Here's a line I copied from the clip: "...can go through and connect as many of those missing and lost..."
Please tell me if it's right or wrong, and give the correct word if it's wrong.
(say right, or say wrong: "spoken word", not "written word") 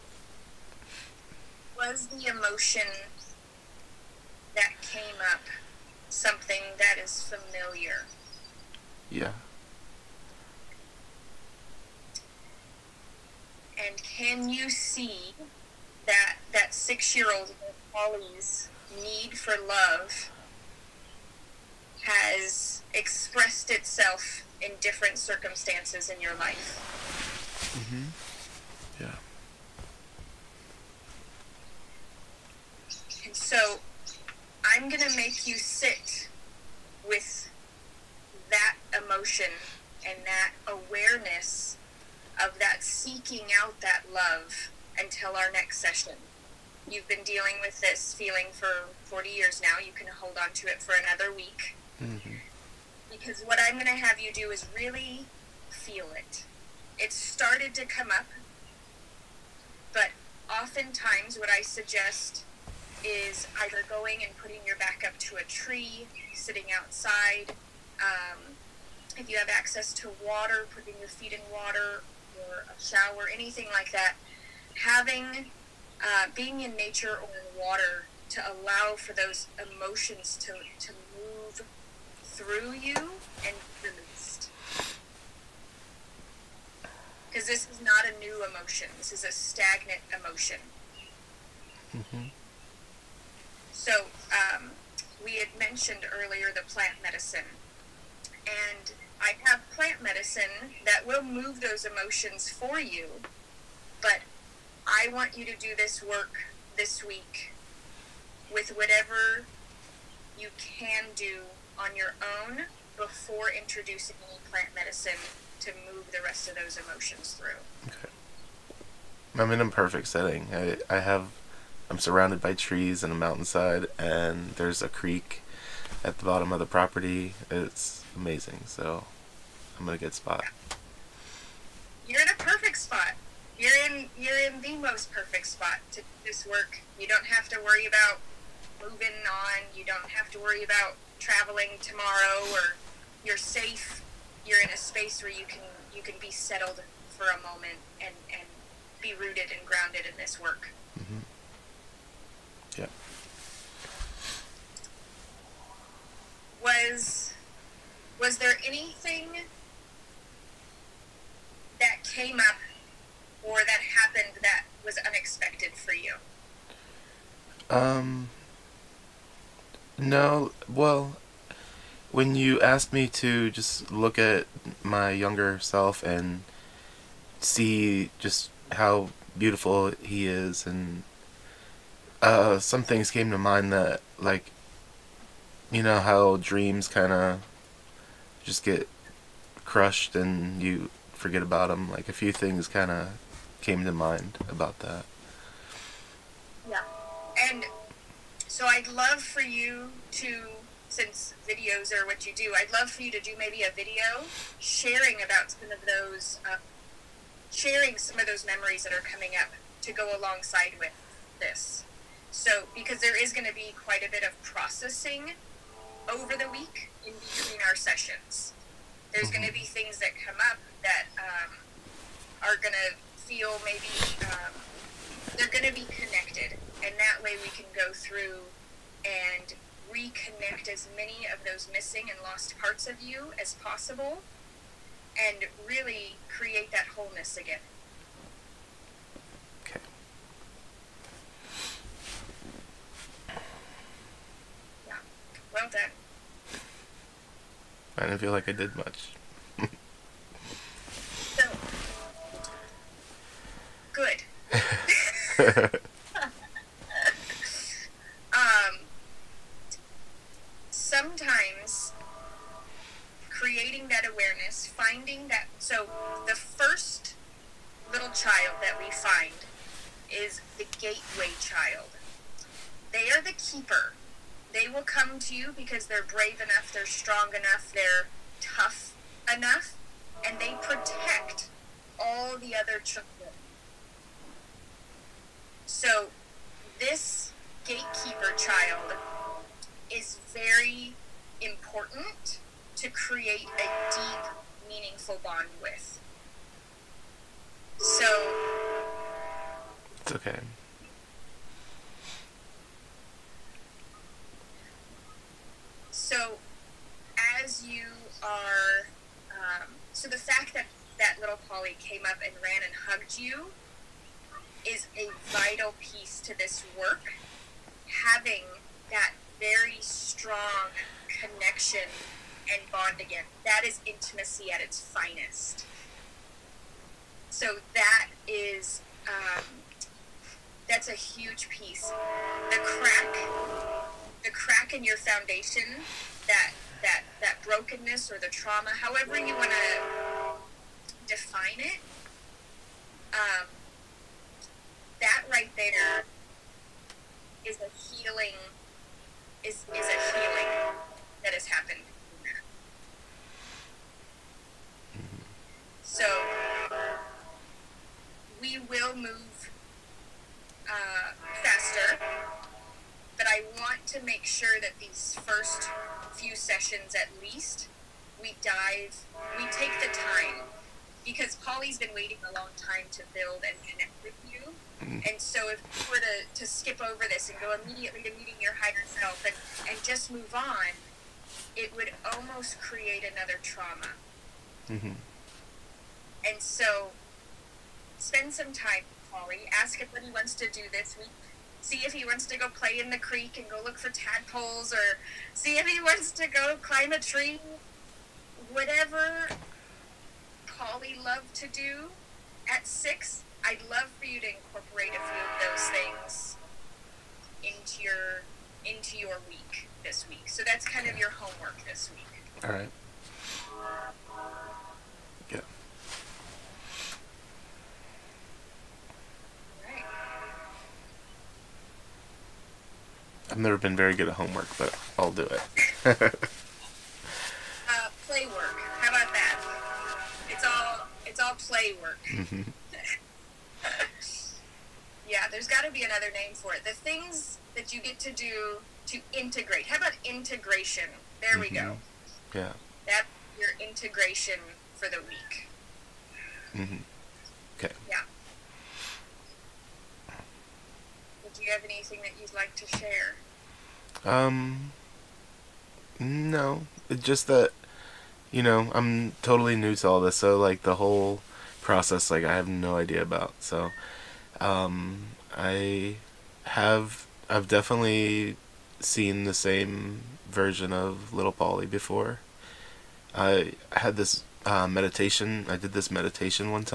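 wrong: "reconnect", not "connect".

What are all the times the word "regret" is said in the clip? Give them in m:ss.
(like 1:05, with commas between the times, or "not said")
not said.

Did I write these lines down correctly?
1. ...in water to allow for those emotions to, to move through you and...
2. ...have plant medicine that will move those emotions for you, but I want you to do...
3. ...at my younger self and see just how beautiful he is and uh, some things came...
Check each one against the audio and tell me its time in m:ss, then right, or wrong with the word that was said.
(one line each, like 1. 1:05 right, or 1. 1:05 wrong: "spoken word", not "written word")
1. 1:17 right
2. 1:39 right
3. 2:54 right.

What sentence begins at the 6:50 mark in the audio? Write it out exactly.
So that's kind of your homework this week.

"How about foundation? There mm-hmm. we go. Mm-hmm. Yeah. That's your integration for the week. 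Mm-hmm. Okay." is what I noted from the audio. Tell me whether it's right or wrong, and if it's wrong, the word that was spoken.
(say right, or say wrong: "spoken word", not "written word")
wrong: "integration", not "foundation".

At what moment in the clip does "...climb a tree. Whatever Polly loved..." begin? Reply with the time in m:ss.
6:36.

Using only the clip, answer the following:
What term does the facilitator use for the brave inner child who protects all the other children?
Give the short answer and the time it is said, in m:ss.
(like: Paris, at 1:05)
Gateway child, at 4:30.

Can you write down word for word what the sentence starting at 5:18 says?
Having that very strong connection and bond again, that is intimacy at its finest.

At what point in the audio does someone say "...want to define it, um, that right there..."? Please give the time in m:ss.
5:39.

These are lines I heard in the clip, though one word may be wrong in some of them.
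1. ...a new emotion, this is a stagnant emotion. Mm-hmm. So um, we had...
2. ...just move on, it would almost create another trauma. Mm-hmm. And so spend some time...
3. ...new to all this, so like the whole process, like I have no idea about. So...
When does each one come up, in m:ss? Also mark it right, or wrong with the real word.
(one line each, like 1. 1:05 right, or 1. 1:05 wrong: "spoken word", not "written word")
1. 1:28 right
2. 6:19 right
3. 7:39 right.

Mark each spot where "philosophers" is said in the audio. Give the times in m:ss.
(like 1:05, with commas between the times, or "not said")
not said.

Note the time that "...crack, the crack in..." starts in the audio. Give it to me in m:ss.
5:32.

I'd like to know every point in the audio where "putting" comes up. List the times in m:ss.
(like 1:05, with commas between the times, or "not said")
1:04, 1:10.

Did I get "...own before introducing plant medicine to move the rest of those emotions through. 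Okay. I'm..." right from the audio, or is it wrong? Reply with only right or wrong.
right.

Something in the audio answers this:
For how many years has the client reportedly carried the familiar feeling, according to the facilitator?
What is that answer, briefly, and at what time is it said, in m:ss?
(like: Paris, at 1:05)
40 years, at 0:49.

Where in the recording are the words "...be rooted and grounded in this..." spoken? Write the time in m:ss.
2:29.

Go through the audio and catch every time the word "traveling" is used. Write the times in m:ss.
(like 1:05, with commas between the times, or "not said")
2:21.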